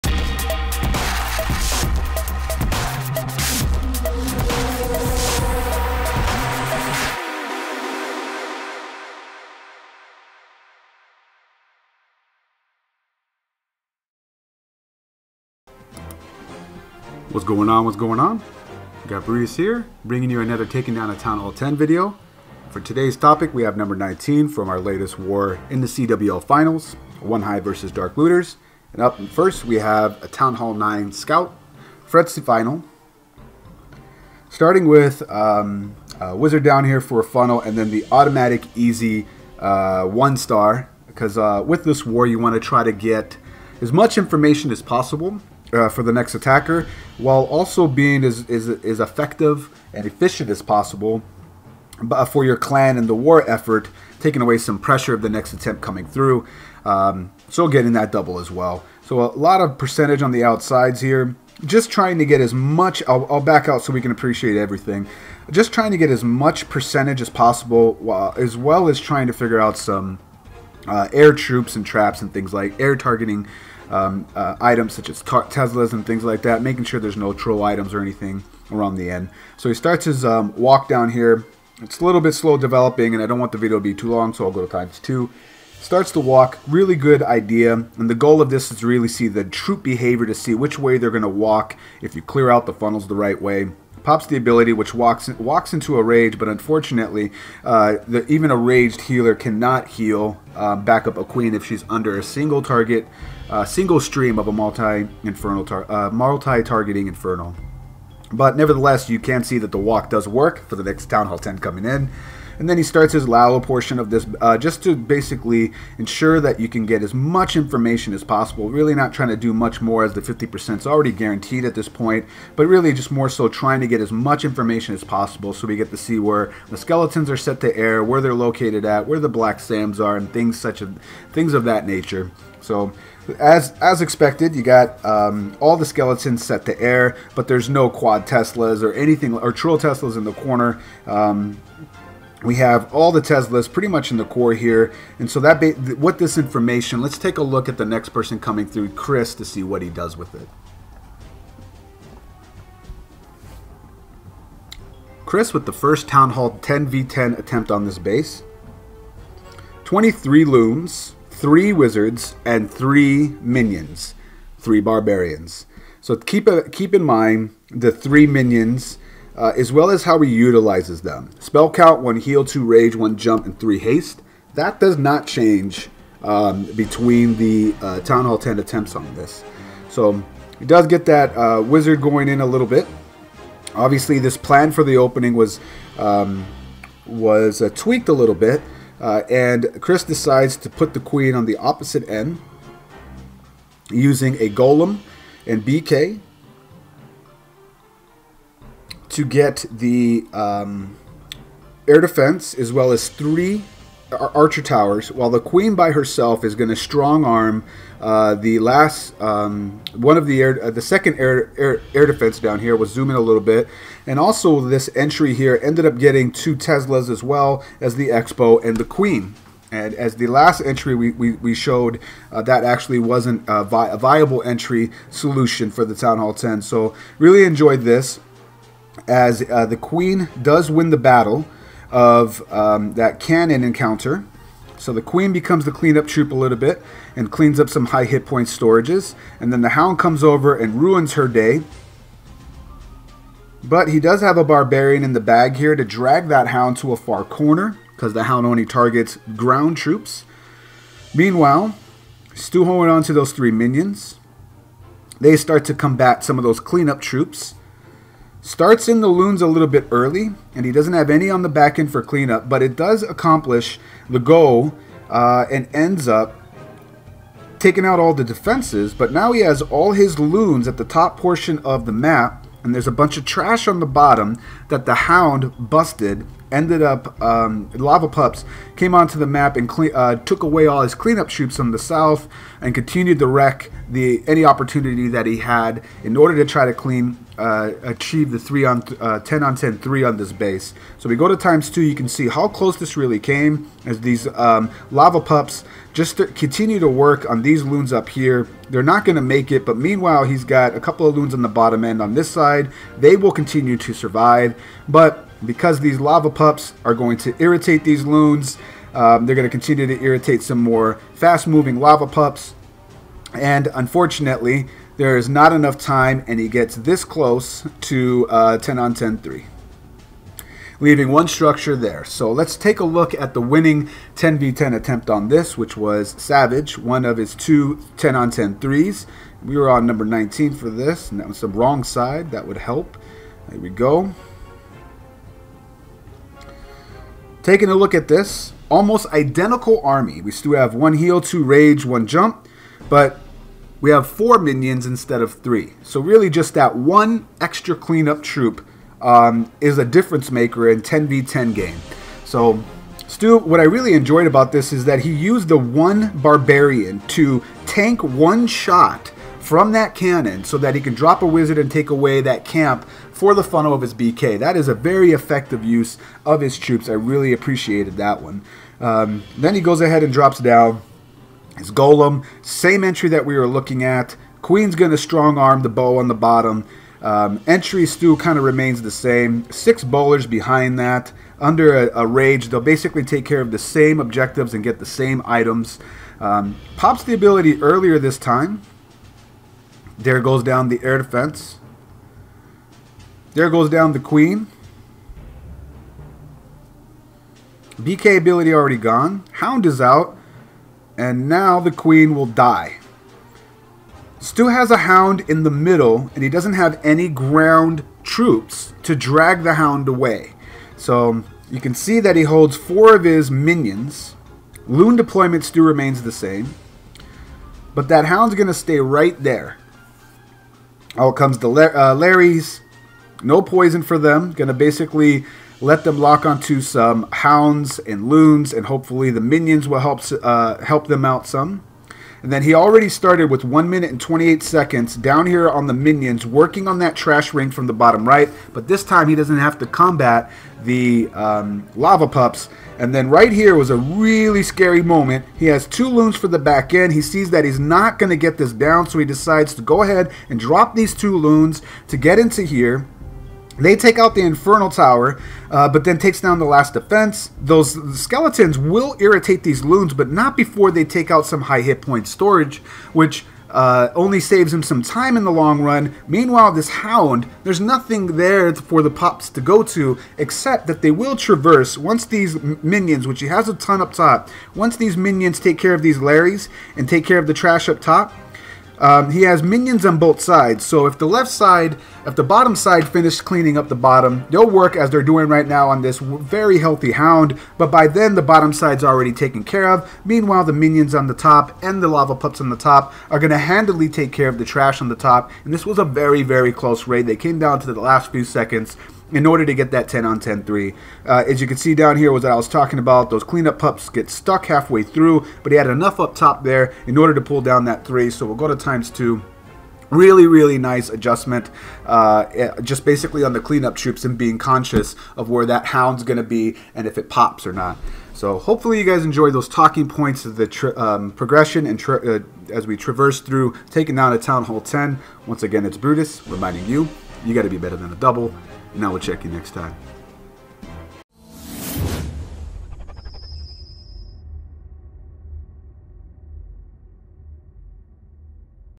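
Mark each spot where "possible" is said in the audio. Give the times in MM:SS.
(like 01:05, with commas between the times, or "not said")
00:44, 00:50, 01:07, 01:58, 02:05.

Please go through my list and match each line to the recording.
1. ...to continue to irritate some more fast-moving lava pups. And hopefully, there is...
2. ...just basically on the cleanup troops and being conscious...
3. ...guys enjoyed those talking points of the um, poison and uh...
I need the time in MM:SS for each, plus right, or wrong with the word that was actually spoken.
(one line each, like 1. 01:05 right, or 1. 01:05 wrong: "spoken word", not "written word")
1. 05:09 wrong: "unfortunately", not "hopefully"
2. 08:32 right
3. 08:38 wrong: "progression", not "poison".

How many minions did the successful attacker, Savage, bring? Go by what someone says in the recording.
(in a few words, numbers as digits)
4.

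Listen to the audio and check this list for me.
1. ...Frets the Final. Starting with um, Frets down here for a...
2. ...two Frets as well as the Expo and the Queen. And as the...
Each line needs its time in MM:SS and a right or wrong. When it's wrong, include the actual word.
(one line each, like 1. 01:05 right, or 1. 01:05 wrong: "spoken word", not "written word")
1. 00:32 wrong: "Wizard", not "Frets"
2. 03:36 wrong: "Teslas", not "Frets".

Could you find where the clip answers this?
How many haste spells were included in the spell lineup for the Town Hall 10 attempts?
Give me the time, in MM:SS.
02:53.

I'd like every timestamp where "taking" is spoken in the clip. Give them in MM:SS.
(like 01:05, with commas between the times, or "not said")
00:20, 00:54, 04:27, 05:37, 08:43.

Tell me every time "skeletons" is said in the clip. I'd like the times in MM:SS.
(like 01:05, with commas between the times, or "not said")
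02:06, 02:15, 07:37.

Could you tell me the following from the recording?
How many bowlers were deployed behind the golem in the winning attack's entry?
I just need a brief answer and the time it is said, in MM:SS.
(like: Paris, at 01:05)
6, at 06:19.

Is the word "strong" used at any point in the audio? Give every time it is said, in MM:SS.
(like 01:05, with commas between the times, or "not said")
03:26, 06:14.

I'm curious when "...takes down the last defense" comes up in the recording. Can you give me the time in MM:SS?
07:35.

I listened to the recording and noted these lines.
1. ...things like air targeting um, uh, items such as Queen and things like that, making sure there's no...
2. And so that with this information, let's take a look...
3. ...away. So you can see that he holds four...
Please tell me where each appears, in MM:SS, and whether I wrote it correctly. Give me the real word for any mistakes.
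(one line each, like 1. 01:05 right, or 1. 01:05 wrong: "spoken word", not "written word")
1. 01:12 wrong: "Teslas", not "Queen"
2. 02:25 right
3. 06:49 right.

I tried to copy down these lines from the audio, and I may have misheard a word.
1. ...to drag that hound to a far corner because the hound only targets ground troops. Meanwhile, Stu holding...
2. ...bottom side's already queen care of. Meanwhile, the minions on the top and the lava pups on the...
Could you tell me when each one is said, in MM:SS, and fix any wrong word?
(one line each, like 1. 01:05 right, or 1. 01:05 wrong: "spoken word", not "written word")
1. 04:05 right
2. 08:08 wrong: "taken", not "queen".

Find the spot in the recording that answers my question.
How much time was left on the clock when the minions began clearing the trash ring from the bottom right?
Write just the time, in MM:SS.
07:13.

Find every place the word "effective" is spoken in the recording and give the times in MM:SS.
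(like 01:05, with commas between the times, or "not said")
00:48, 06:05.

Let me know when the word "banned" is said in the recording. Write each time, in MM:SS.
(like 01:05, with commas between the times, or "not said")
not said.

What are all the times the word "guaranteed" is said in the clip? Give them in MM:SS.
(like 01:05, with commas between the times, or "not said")
02:01.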